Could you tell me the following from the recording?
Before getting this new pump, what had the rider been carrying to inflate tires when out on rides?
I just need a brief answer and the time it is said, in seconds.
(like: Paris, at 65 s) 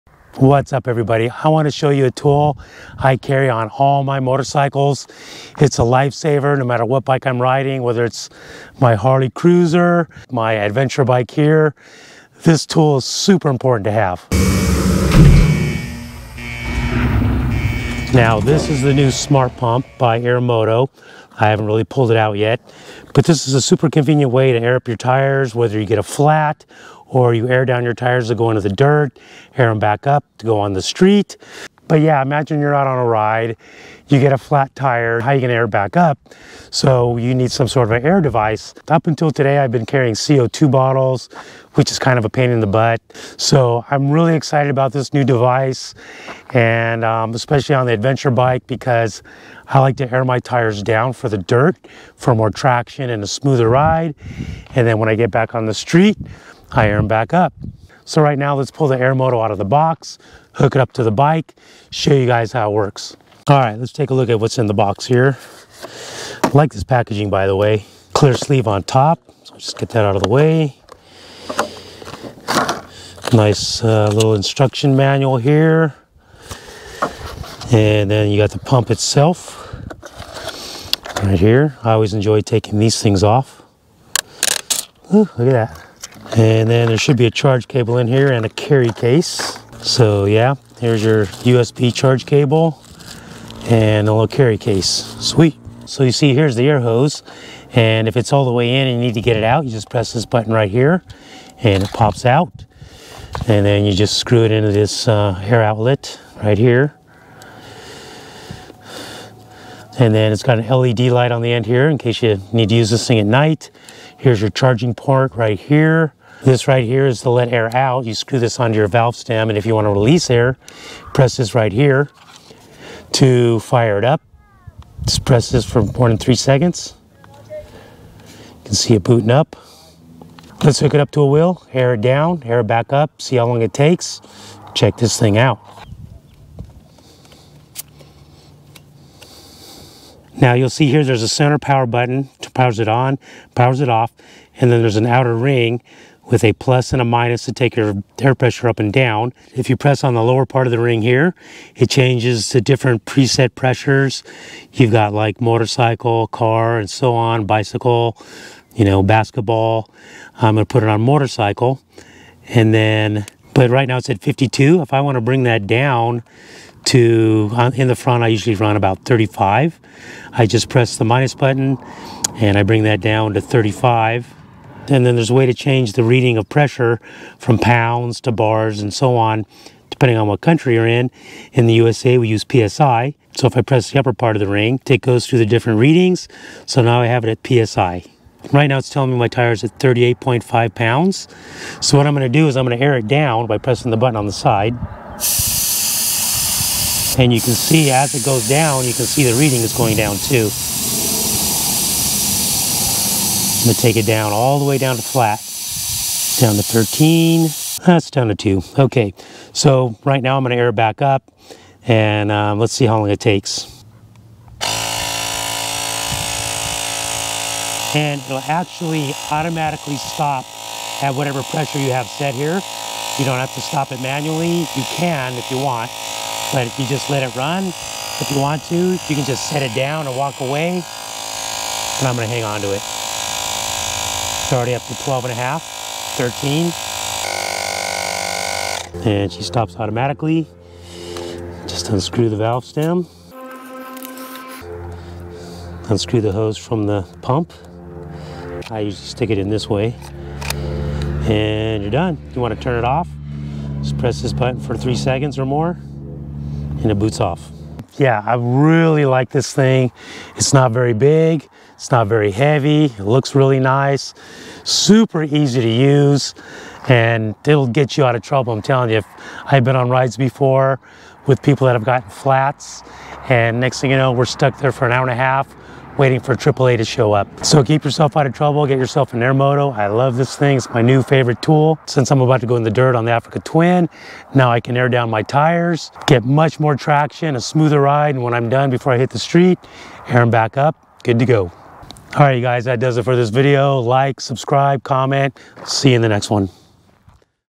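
CO2 bottles, at 40 s.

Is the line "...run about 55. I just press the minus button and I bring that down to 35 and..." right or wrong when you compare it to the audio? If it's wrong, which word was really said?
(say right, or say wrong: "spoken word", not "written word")
wrong: "35", not "55".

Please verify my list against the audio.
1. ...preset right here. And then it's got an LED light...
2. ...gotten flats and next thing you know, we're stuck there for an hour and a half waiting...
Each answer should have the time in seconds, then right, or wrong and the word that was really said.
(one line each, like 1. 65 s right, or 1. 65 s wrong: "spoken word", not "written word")
1. 105 s wrong: "outlet", not "preset"
2. 271 s right.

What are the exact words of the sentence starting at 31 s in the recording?
But yeah, imagine you're out on a ride, you get a flat tire, how you gonna air back up?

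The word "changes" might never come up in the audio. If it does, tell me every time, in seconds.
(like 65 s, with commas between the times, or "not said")
151 s, 175 s.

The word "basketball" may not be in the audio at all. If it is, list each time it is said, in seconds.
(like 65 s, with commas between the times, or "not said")
159 s.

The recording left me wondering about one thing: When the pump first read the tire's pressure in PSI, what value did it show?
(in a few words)
38.5.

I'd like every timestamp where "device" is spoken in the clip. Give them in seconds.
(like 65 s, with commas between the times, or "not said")
38 s, 45 s.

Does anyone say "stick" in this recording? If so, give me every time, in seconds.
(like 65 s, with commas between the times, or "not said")
249 s.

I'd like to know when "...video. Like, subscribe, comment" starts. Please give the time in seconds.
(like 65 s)
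293 s.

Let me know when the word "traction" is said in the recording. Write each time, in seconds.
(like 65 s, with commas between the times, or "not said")
52 s, 286 s.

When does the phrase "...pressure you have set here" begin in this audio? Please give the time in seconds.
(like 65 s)
221 s.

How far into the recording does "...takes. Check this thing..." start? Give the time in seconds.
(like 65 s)
133 s.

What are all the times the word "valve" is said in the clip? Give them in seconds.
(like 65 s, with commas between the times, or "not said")
118 s, 242 s.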